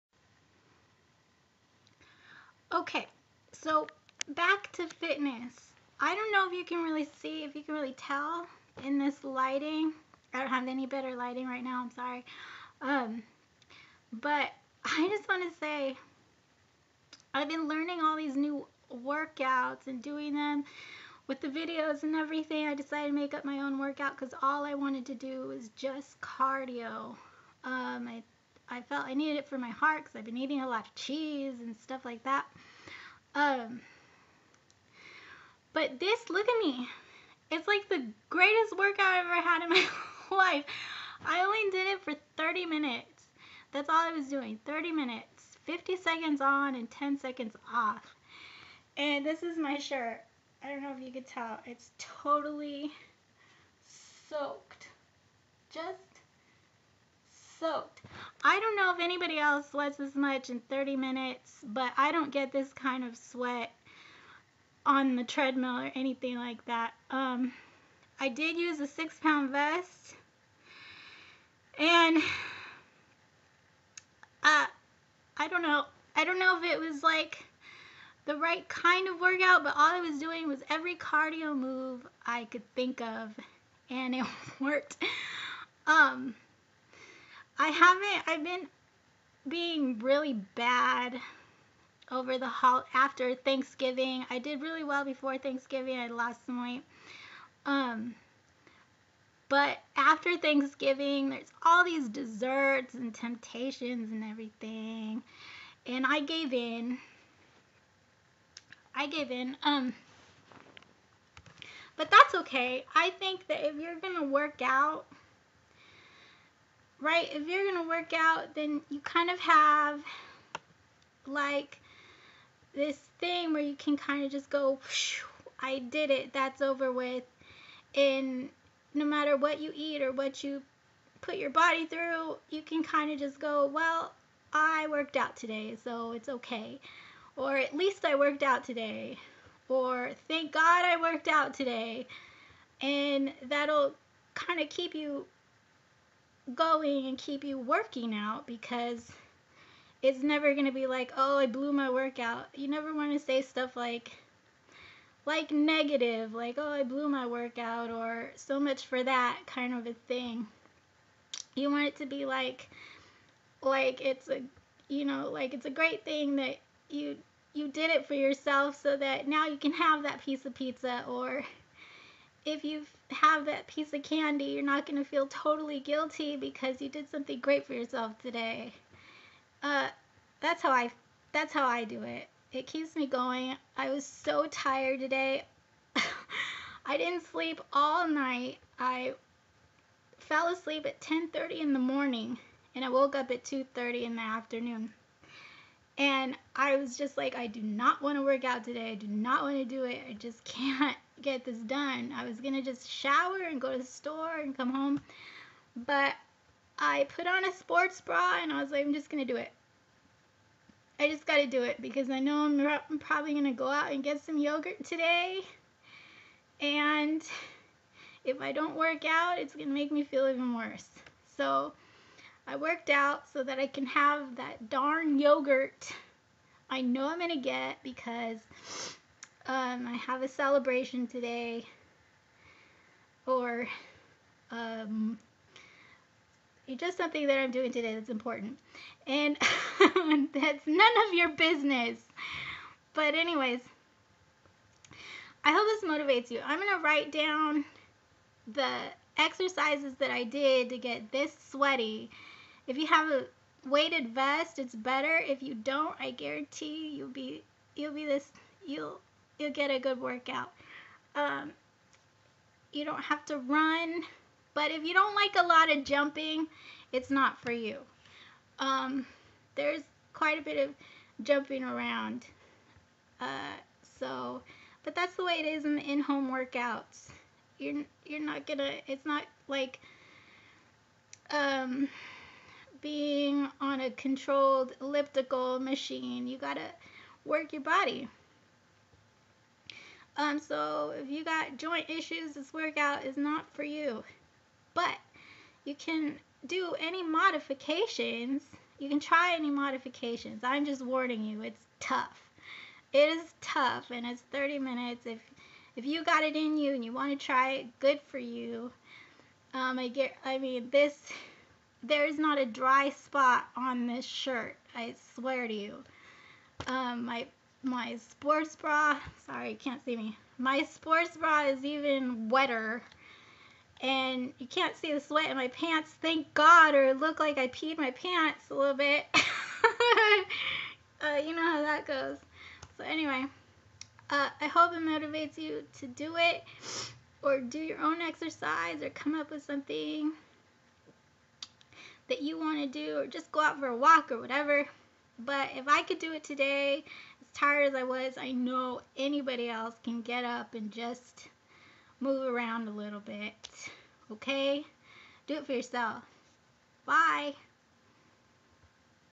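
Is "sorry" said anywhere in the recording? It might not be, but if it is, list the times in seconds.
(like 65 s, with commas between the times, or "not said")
11 s, 319 s.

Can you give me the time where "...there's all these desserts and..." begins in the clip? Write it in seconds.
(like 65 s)
101 s.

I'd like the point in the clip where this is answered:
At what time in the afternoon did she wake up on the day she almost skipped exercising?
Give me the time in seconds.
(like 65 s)
193 s.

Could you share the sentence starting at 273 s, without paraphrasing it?
Uh, so, but that's the way it is in in-home workouts.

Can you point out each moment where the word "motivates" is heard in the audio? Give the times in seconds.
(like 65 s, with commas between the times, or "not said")
245 s, 334 s.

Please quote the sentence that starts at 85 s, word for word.
Um, I haven't, I've been being really bad over the whole after Thanksgiving.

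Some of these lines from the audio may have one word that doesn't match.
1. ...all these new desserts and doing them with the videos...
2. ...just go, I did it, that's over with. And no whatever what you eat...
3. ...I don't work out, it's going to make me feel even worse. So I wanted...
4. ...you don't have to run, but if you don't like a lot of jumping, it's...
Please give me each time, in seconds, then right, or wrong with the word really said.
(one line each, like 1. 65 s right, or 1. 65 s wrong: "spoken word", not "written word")
1. 18 s wrong: "workouts", not "desserts"
2. 124 s wrong: "matter", not "whatever"
3. 218 s wrong: "worked", not "wanted"
4. 262 s right.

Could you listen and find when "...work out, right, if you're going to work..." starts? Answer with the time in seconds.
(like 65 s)
114 s.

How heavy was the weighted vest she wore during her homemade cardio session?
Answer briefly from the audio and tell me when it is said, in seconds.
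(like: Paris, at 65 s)
6 pounds, at 68 s.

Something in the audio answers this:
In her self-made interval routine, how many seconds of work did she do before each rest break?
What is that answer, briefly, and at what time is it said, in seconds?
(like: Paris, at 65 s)
50 seconds, at 45 s.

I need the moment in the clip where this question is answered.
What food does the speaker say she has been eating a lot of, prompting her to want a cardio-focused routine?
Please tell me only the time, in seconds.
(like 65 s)
30 s.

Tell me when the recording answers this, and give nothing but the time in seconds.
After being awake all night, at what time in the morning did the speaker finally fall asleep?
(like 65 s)
190 s.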